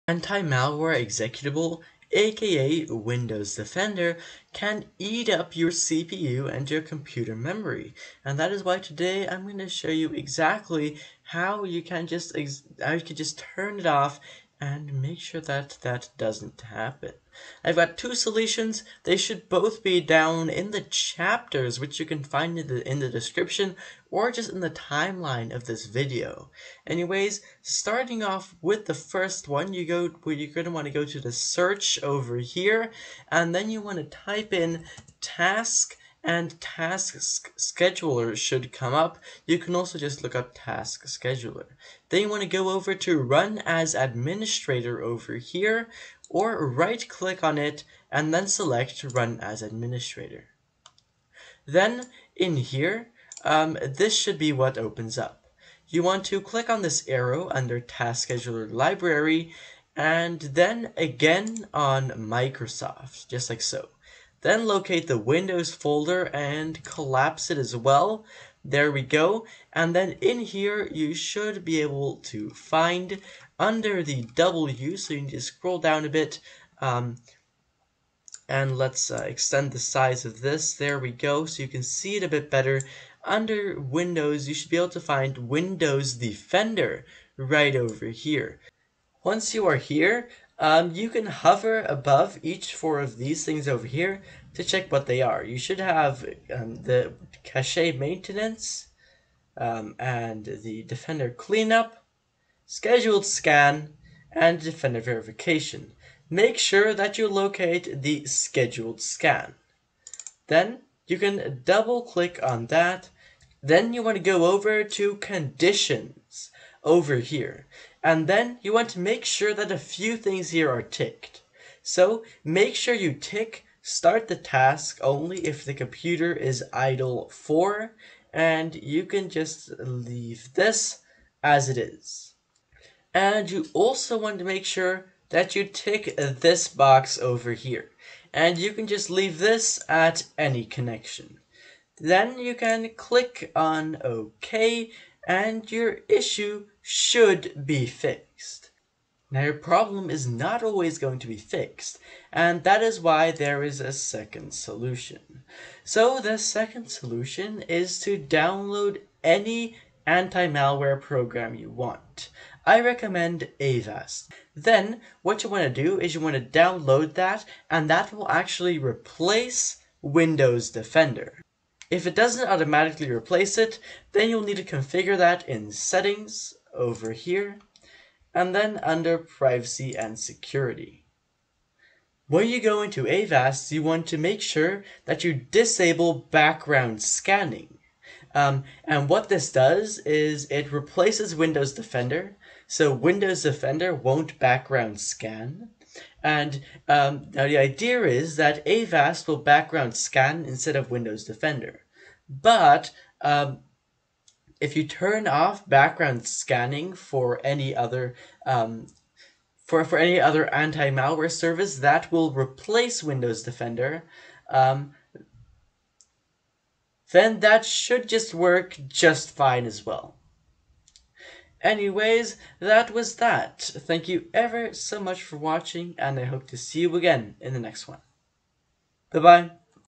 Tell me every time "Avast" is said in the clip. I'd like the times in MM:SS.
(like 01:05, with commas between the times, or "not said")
02:43, 03:03, 03:18.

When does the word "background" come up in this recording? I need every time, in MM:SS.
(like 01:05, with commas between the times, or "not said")
03:06, 03:14, 03:19, 03:25.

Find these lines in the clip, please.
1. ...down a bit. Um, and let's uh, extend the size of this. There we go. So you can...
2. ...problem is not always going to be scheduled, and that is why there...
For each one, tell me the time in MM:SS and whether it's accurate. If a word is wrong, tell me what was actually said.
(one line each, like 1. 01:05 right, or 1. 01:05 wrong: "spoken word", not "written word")
1. 01:15 right
2. 02:29 wrong: "fixed", not "scheduled".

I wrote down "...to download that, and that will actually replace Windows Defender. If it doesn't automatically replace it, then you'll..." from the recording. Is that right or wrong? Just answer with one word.
right.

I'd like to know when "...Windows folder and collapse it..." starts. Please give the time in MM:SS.
01:05.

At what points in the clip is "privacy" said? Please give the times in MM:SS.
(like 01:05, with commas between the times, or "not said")
02:59.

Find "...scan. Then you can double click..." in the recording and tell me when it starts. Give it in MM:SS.
01:49.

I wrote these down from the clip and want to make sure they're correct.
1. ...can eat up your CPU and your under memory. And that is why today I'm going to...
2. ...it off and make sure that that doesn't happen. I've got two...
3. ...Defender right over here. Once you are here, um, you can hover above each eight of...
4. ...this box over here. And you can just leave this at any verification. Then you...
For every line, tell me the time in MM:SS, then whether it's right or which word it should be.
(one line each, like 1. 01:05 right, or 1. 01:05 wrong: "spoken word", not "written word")
1. 00:04 wrong: "computer", not "under"
2. 00:13 right
3. 01:26 wrong: "four", not "eight"
4. 02:16 wrong: "connection", not "verification".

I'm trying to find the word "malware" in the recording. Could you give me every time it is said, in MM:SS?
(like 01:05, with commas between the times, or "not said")
00:00, 02:40, 03:30.